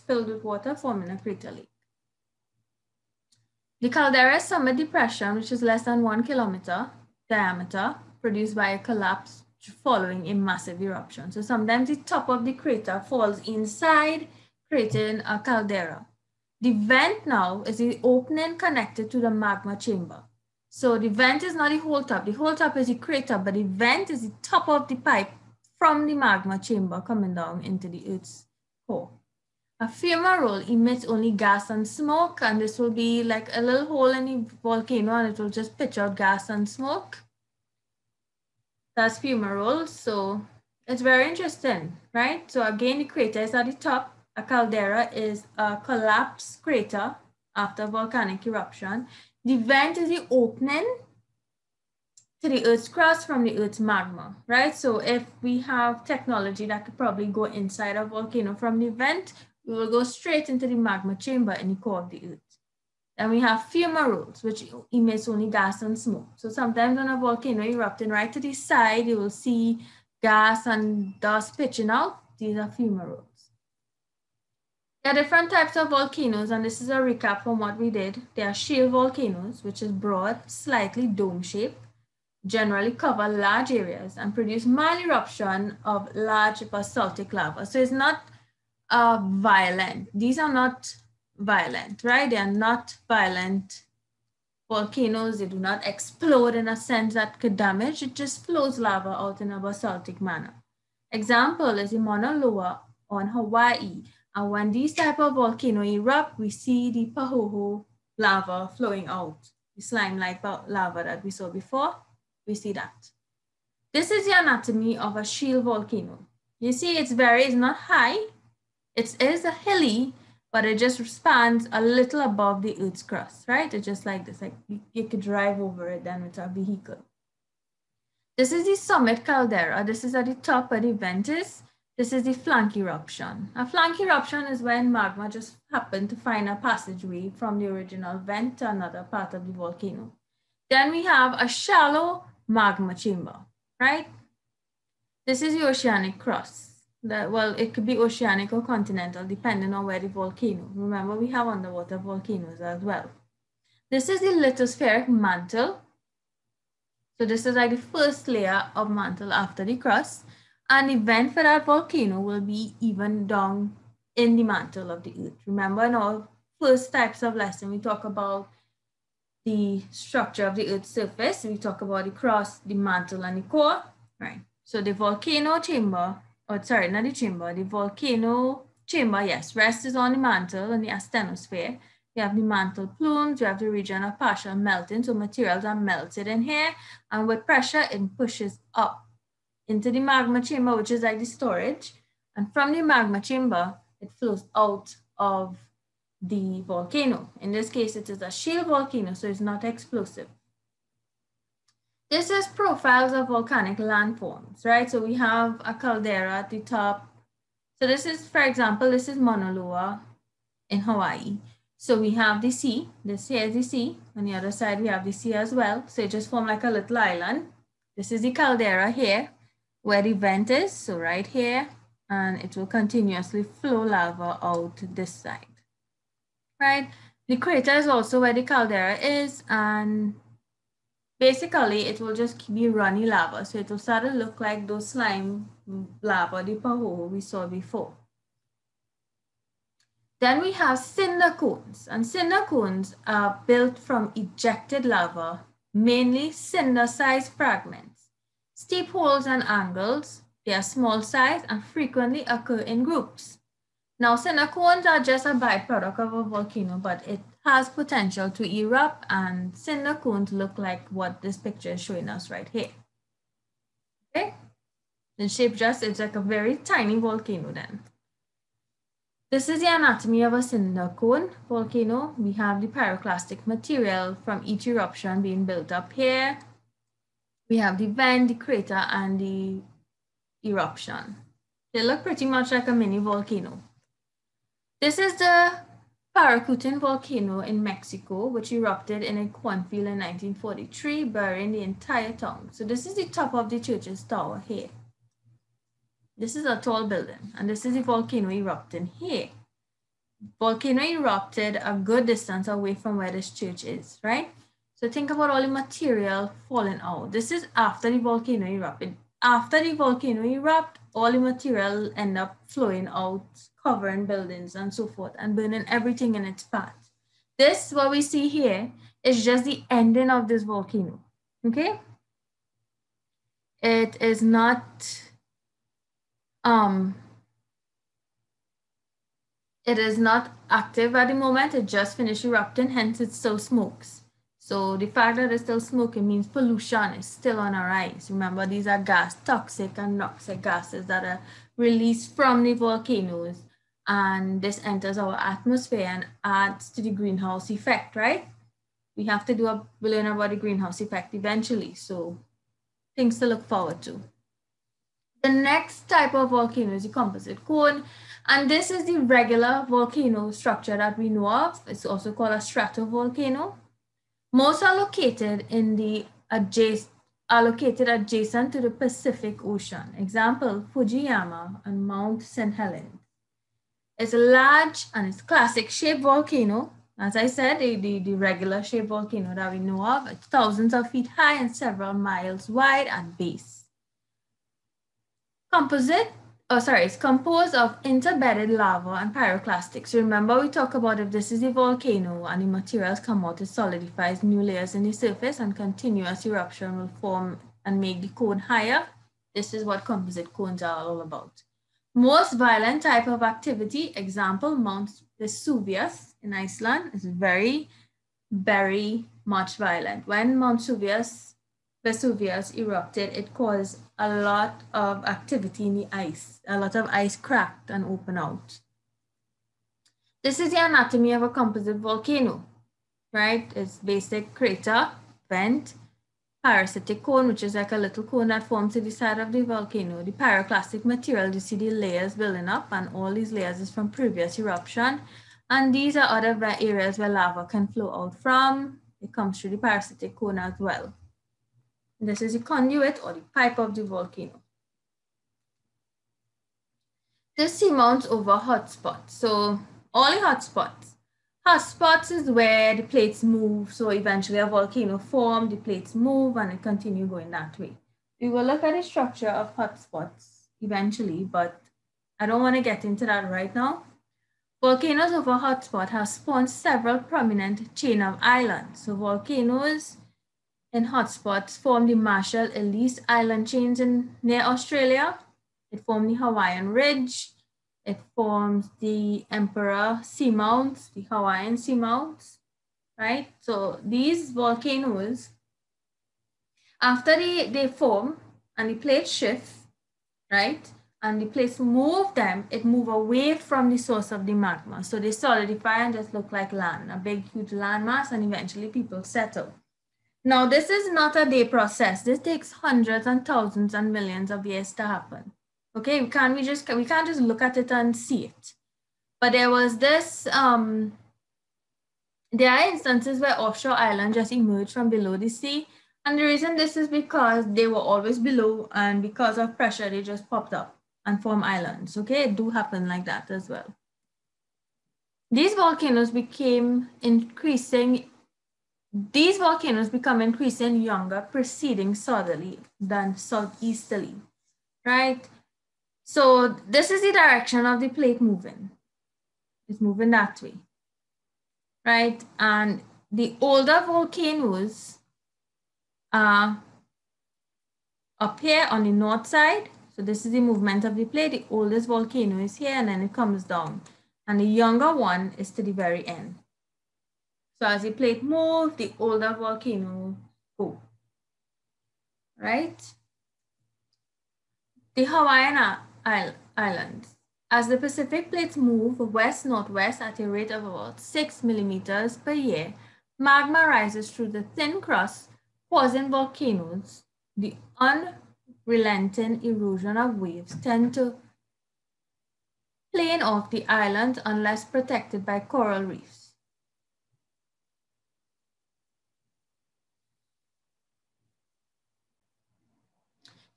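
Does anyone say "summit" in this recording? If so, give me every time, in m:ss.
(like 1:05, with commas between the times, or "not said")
0:04, 2:08.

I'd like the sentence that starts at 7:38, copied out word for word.
We will look at the structure of hotspots eventually, but I don't want to get into that right now.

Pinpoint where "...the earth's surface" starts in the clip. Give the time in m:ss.
2:50.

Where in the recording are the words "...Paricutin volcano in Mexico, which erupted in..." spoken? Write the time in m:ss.
4:46.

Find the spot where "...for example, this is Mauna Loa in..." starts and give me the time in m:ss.
3:28.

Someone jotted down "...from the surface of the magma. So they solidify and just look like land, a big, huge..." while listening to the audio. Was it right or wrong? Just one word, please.
wrong.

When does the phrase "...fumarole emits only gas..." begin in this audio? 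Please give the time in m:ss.
0:29.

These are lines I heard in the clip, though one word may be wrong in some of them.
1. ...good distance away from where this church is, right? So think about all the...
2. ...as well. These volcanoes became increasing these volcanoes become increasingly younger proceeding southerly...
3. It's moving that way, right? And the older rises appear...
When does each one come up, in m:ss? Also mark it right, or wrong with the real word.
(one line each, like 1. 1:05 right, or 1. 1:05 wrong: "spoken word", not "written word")
1. 5:01 right
2. 8:43 right
3. 8:59 wrong: "volcanoes", not "rises".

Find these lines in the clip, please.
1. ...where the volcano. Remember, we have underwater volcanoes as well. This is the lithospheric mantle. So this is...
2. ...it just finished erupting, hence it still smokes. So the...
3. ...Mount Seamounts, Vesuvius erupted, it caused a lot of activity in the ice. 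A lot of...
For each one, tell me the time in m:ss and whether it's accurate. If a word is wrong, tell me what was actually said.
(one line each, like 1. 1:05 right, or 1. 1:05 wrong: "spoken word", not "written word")
1. 2:29 right
2. 5:31 right
3. 6:50 wrong: "Vesuvius", not "Seamounts".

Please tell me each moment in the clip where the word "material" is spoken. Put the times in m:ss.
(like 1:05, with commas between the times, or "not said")
3:05, 4:33, 5:05, 5:11, 6:32, 7:10.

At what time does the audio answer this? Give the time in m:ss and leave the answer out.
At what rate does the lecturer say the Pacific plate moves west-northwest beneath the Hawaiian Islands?
9:30.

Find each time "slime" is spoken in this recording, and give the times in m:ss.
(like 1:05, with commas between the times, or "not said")
1:49, 3:54.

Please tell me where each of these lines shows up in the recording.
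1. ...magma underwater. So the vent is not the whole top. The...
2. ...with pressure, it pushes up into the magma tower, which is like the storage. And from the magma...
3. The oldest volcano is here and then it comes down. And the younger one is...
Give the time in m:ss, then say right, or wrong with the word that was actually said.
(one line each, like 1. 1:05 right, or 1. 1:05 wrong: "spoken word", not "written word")
1. 0:19 wrong: "chamber", not "underwater"
2. 3:07 wrong: "chamber", not "tower"
3. 9:11 right.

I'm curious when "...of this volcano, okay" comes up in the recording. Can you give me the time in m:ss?
5:20.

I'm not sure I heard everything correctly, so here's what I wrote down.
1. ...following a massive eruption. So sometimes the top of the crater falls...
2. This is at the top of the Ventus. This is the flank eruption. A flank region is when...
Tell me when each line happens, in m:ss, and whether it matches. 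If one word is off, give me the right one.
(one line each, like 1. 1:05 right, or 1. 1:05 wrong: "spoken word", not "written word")
1. 0:09 right
2. 2:09 wrong: "eruption", not "region".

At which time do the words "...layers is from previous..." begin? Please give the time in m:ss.
7:13.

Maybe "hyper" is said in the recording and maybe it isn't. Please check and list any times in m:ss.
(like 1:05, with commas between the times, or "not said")
not said.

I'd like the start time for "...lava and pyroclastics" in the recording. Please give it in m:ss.
6:28.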